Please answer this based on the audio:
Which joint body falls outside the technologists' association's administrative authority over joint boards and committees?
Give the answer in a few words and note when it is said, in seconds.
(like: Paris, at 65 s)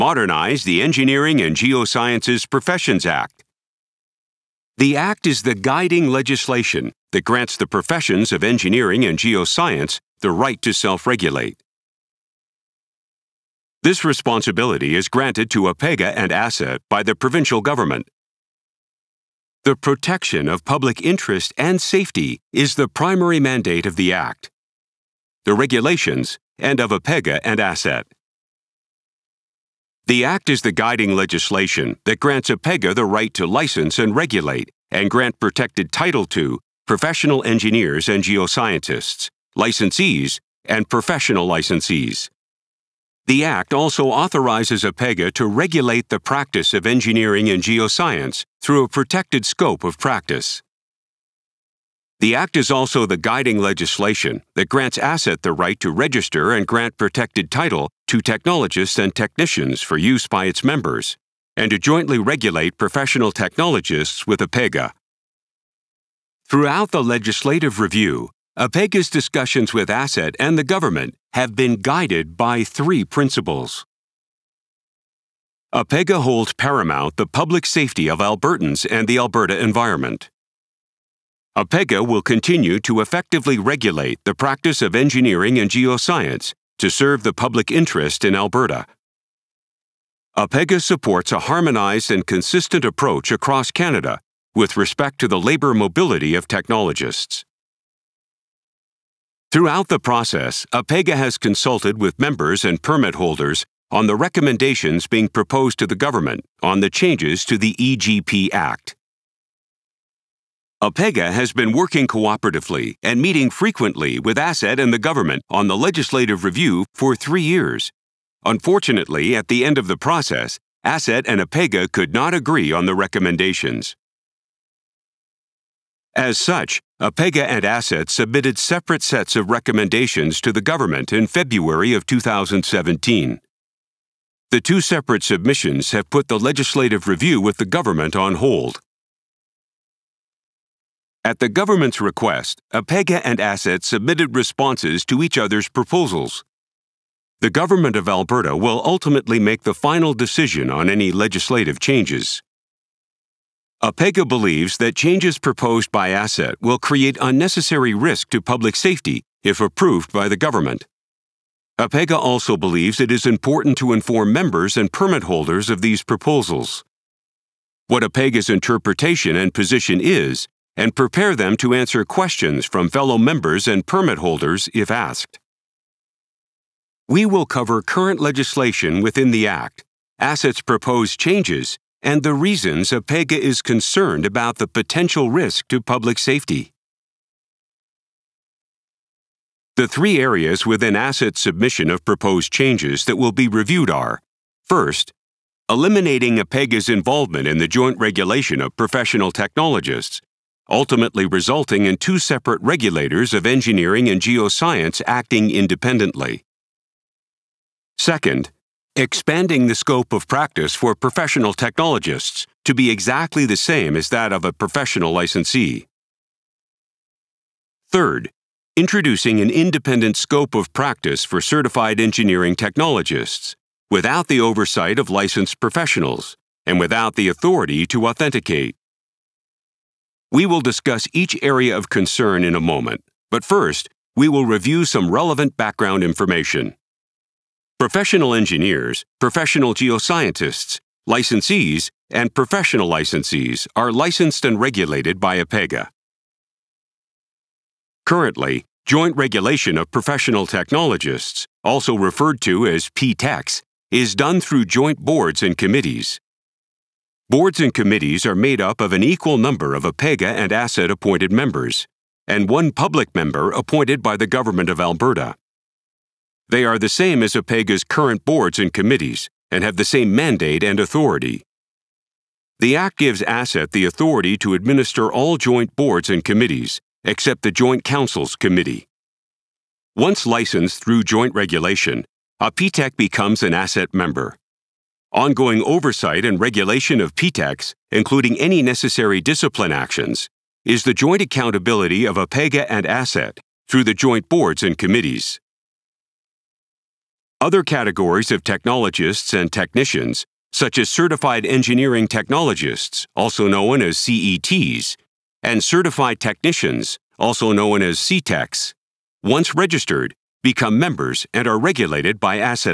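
Joint Councils Committee, at 277 s.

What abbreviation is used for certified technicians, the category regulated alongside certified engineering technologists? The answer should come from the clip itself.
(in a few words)
CTECs.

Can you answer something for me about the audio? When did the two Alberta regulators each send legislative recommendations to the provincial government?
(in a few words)
February 2017.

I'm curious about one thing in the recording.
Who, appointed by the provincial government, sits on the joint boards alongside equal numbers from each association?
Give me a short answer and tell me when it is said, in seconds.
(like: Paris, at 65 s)
one public member, at 262 s.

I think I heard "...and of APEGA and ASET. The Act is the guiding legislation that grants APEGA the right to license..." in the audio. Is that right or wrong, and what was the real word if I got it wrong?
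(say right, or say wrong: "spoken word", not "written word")
right.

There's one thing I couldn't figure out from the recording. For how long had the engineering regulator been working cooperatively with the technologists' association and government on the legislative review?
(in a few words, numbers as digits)
three years.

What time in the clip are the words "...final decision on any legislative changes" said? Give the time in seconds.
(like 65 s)
149 s.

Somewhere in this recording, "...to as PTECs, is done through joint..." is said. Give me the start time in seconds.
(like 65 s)
252 s.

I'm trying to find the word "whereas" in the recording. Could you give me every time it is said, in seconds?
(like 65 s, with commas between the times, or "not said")
not said.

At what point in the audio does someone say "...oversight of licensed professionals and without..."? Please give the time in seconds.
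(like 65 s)
224 s.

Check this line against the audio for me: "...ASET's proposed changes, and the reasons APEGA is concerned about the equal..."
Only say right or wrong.
wrong.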